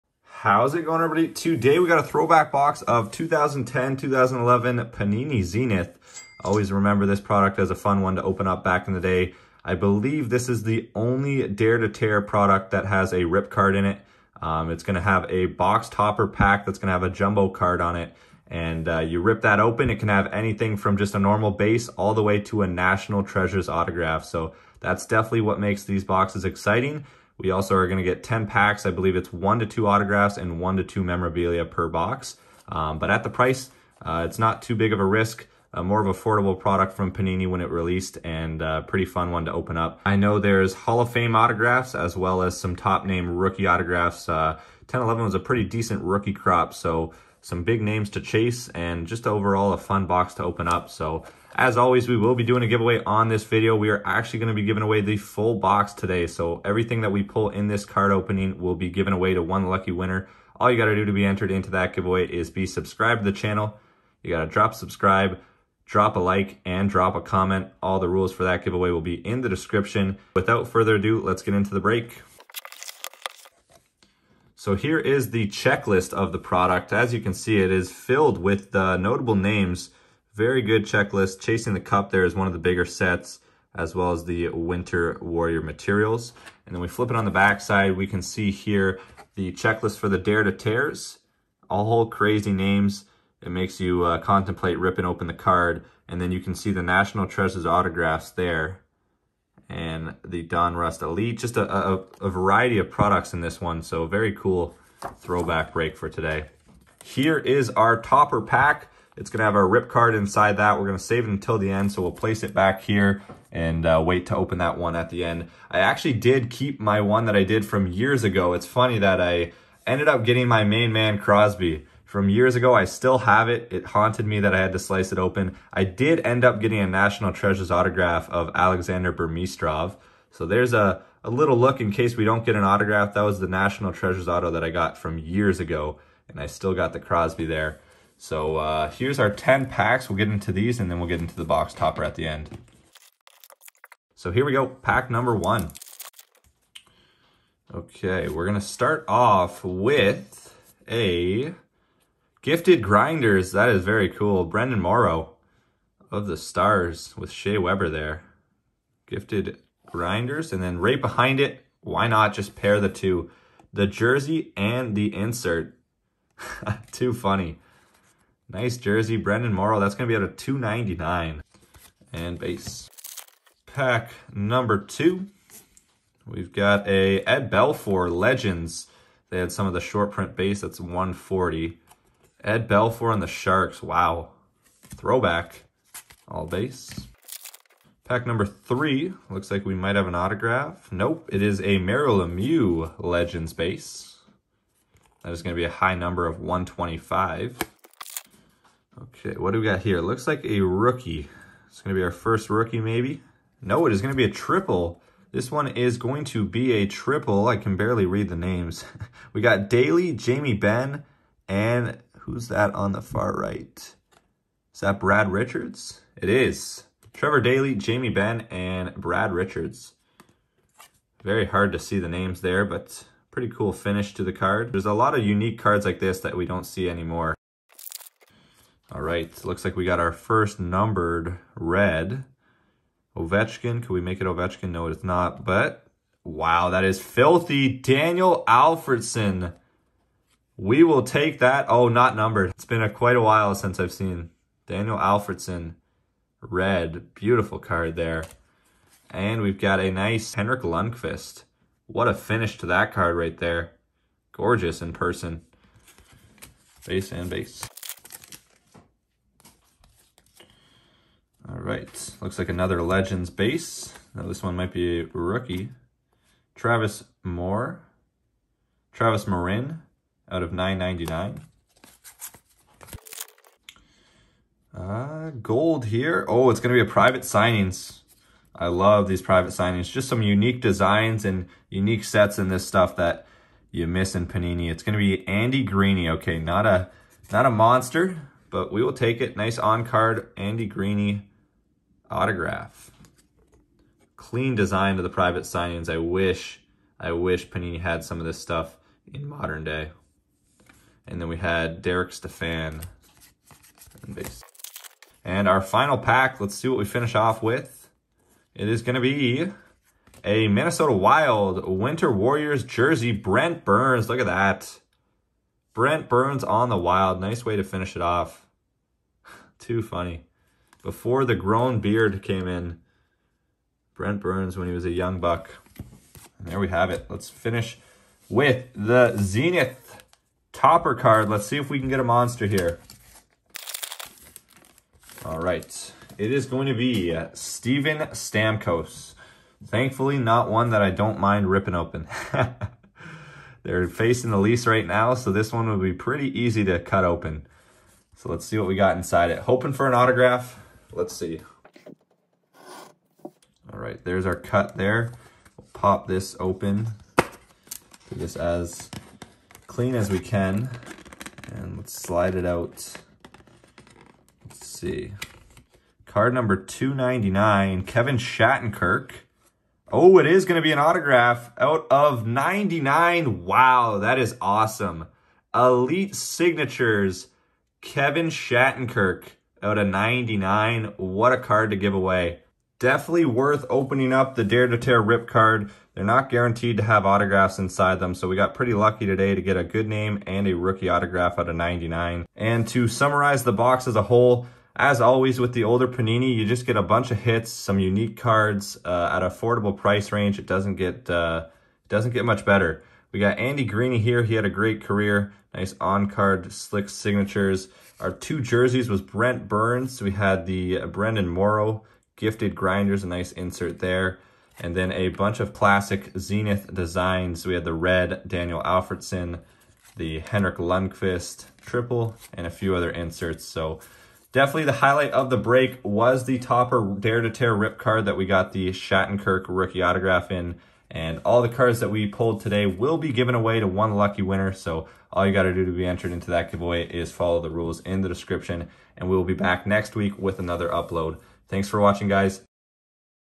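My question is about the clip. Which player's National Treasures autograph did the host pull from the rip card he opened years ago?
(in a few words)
Alexander Burmistrov.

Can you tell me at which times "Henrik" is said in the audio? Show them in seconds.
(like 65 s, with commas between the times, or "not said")
250 s, 420 s.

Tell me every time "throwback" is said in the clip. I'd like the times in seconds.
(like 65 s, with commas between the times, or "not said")
2 s, 105 s, 184 s.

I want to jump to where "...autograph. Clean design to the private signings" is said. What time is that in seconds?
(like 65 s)
292 s.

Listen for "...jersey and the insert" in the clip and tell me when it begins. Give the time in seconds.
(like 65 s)
163 s.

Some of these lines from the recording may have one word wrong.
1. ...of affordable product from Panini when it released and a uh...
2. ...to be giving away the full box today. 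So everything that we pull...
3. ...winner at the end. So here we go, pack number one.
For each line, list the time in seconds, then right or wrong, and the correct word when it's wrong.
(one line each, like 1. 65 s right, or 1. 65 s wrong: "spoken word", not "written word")
1. 36 s right
2. 54 s right
3. 141 s wrong: "topper", not "winner".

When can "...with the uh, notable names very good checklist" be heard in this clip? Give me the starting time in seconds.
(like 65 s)
78 s.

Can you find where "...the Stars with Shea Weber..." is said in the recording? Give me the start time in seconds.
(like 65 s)
156 s.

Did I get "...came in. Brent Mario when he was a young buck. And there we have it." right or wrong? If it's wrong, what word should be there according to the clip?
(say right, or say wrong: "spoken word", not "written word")
wrong: "Burns", not "Mario".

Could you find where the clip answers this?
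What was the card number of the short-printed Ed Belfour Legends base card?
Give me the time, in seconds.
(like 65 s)
180 s.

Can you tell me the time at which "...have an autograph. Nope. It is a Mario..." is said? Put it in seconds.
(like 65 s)
189 s.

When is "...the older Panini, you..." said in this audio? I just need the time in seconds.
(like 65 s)
395 s.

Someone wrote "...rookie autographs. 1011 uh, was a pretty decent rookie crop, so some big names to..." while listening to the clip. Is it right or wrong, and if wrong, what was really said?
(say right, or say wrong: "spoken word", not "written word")
right.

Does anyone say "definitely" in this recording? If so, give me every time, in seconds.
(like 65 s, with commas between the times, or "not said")
25 s, 382 s, 424 s.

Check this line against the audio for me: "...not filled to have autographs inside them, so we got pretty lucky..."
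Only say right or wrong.
wrong.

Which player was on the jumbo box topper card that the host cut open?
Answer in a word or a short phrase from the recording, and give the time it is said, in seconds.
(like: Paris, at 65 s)
Steven Stamkos, at 337 s.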